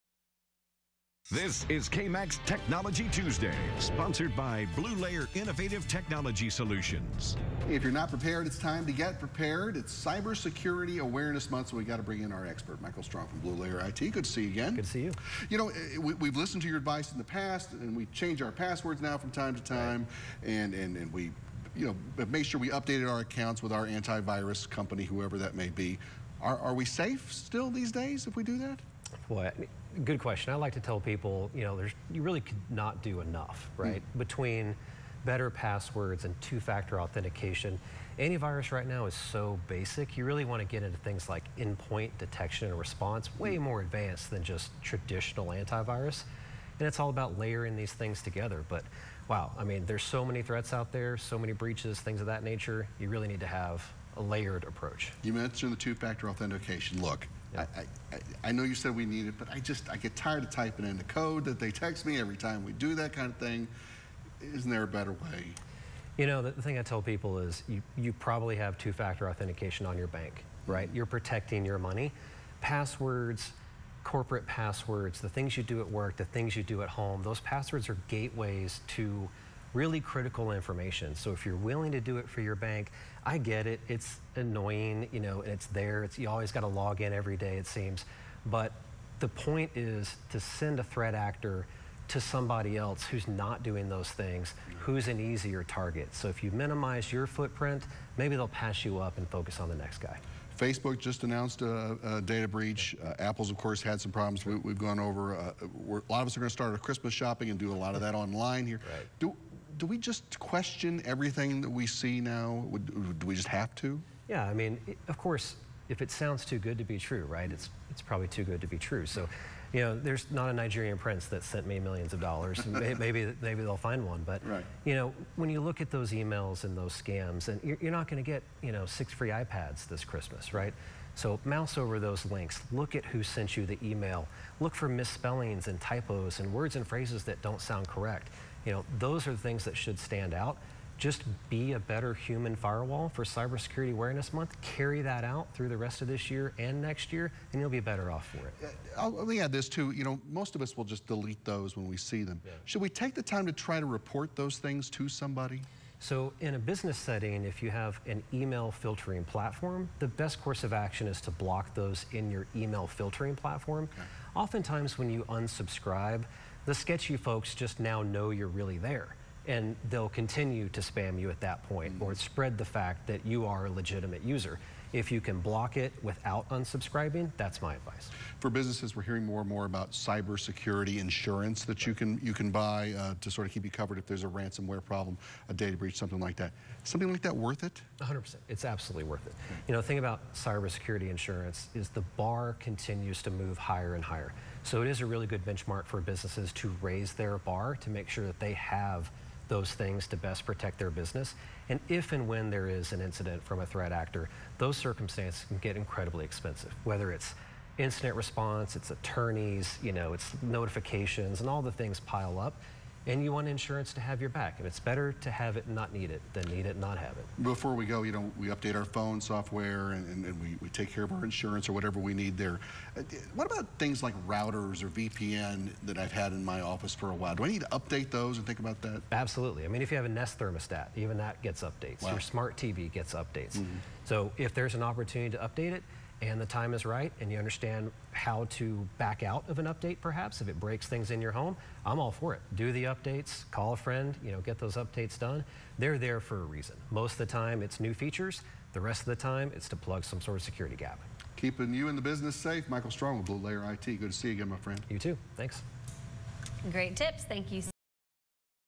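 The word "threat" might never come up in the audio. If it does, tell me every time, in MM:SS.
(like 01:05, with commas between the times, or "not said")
00:50, 01:30, 03:23.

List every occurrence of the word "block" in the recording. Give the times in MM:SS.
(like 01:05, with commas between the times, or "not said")
02:41, 02:55.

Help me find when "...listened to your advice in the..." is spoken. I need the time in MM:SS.
00:16.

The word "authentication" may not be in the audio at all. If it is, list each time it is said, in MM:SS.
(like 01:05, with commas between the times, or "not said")
00:36, 00:56, 01:09.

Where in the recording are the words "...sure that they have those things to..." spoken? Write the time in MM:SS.
03:18.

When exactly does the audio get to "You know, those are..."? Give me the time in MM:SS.
02:18.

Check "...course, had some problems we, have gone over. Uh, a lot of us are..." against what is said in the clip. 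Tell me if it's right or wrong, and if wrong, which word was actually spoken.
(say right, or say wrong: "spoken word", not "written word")
right.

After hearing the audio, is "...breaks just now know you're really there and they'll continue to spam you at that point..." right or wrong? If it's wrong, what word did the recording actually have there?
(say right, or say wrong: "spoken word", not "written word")
wrong: "folks", not "breaks".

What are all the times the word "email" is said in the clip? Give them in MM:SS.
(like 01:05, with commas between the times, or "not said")
02:06, 02:13, 02:38, 02:42.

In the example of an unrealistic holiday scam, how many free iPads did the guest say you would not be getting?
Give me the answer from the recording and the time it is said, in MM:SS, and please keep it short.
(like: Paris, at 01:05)
6, at 02:08.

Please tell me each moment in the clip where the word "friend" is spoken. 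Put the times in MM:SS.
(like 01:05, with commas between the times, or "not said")
04:03, 04:14.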